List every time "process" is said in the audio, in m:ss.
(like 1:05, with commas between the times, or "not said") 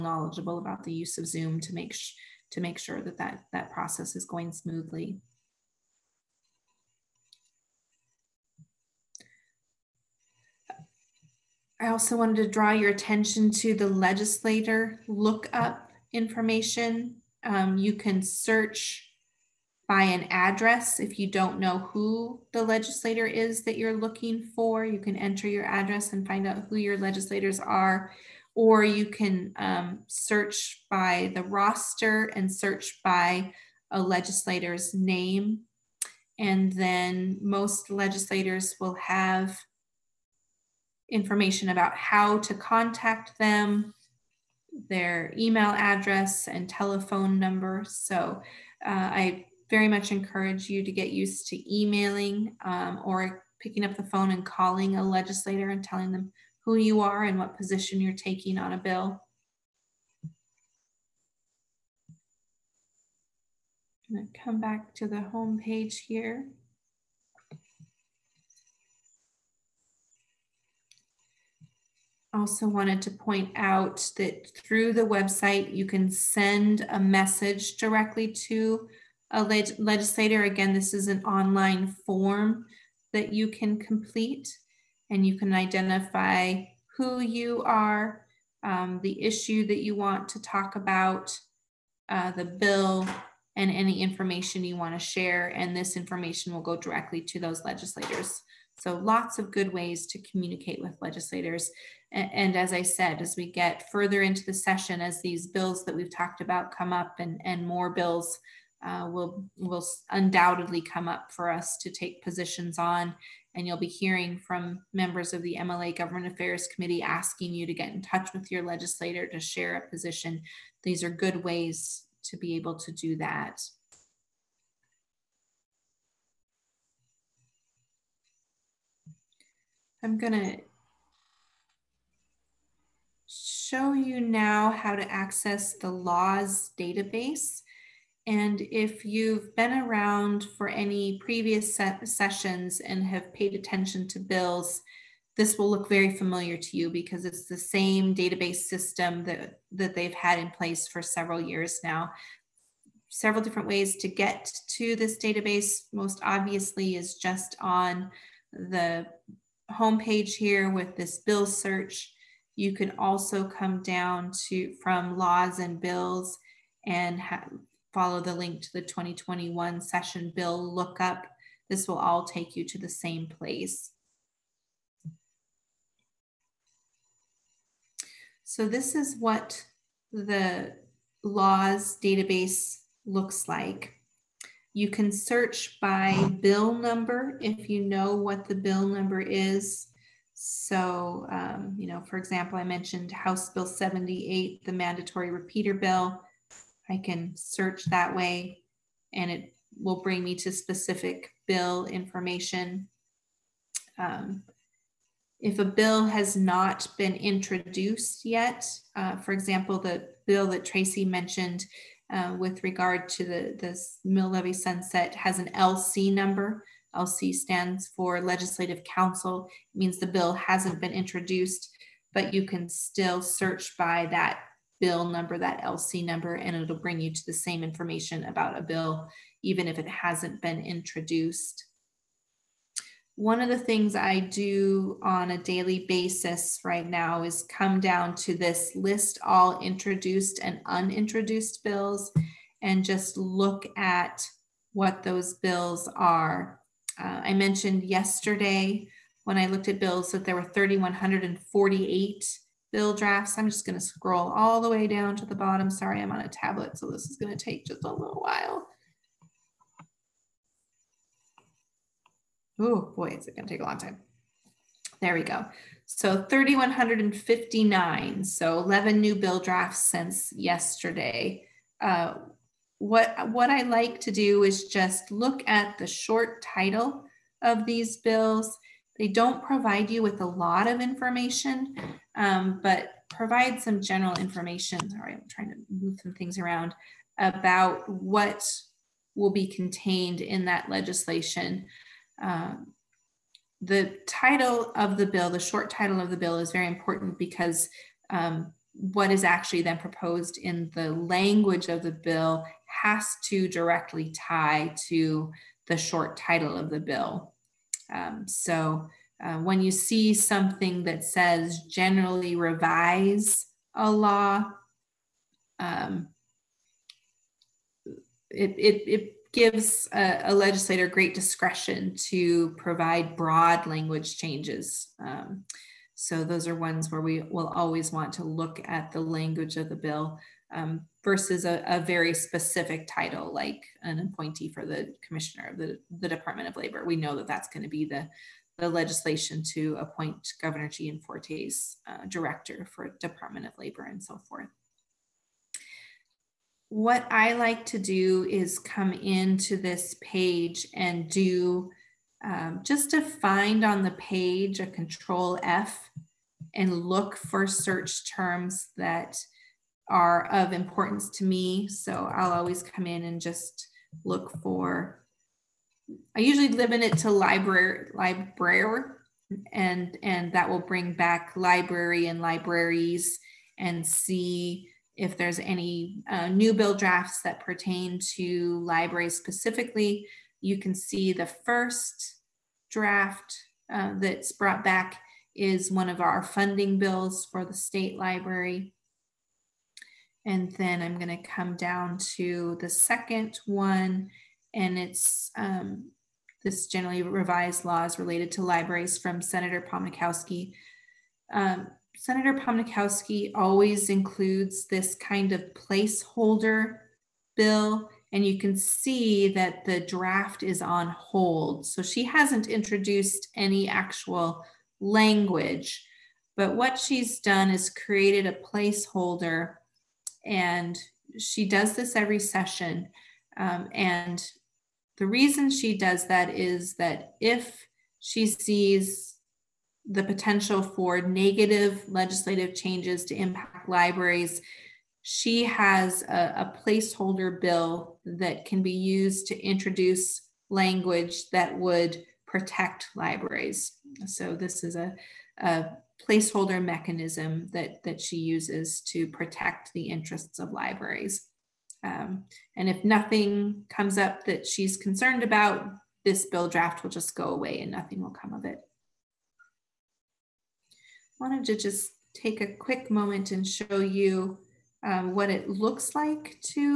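0:03.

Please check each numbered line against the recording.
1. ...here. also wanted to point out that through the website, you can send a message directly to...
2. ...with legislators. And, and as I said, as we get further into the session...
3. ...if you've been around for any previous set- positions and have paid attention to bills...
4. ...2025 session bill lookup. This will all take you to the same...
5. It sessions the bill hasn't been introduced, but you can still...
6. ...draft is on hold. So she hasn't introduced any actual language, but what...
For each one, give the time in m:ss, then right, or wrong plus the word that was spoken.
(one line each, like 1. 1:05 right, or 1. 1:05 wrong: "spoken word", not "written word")
1. 1:06 right
2. 1:40 right
3. 2:18 wrong: "sessions", not "positions"
4. 2:48 wrong: "2021", not "2025"
5. 3:39 wrong: "means", not "sessions"
6. 6:49 right.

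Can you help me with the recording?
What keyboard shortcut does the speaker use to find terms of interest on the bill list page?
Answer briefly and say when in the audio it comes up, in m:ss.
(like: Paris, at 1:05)
Control F, at 5:54.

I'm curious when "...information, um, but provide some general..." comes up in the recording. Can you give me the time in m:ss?
4:40.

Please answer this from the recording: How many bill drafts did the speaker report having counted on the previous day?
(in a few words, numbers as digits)
3,148.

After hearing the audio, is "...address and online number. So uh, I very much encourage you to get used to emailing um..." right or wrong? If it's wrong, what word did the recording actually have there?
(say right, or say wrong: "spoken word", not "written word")
wrong: "telephone", not "online".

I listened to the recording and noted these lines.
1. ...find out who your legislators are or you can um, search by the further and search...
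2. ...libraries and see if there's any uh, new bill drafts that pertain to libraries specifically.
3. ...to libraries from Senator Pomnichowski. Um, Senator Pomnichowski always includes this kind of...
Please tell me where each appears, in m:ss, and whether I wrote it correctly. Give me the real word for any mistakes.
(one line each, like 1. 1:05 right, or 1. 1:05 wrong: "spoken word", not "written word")
1. 0:26 wrong: "roster", not "further"
2. 6:12 right
3. 6:38 right.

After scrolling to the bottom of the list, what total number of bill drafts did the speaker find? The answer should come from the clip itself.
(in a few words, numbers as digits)
3,159.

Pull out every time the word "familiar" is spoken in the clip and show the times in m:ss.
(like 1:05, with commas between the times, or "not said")
2:26.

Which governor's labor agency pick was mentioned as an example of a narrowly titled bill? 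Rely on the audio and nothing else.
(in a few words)
Gianforte.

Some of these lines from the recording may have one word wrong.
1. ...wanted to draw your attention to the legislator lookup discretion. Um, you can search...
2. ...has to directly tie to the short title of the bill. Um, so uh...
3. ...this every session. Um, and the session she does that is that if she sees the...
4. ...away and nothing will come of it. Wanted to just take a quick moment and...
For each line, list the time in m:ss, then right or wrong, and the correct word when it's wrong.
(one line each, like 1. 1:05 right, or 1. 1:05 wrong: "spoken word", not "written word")
1. 0:12 wrong: "information", not "discretion"
2. 5:02 right
3. 7:01 wrong: "reason", not "session"
4. 7:37 right.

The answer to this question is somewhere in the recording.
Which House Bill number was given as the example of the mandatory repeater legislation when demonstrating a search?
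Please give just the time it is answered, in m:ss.
3:13.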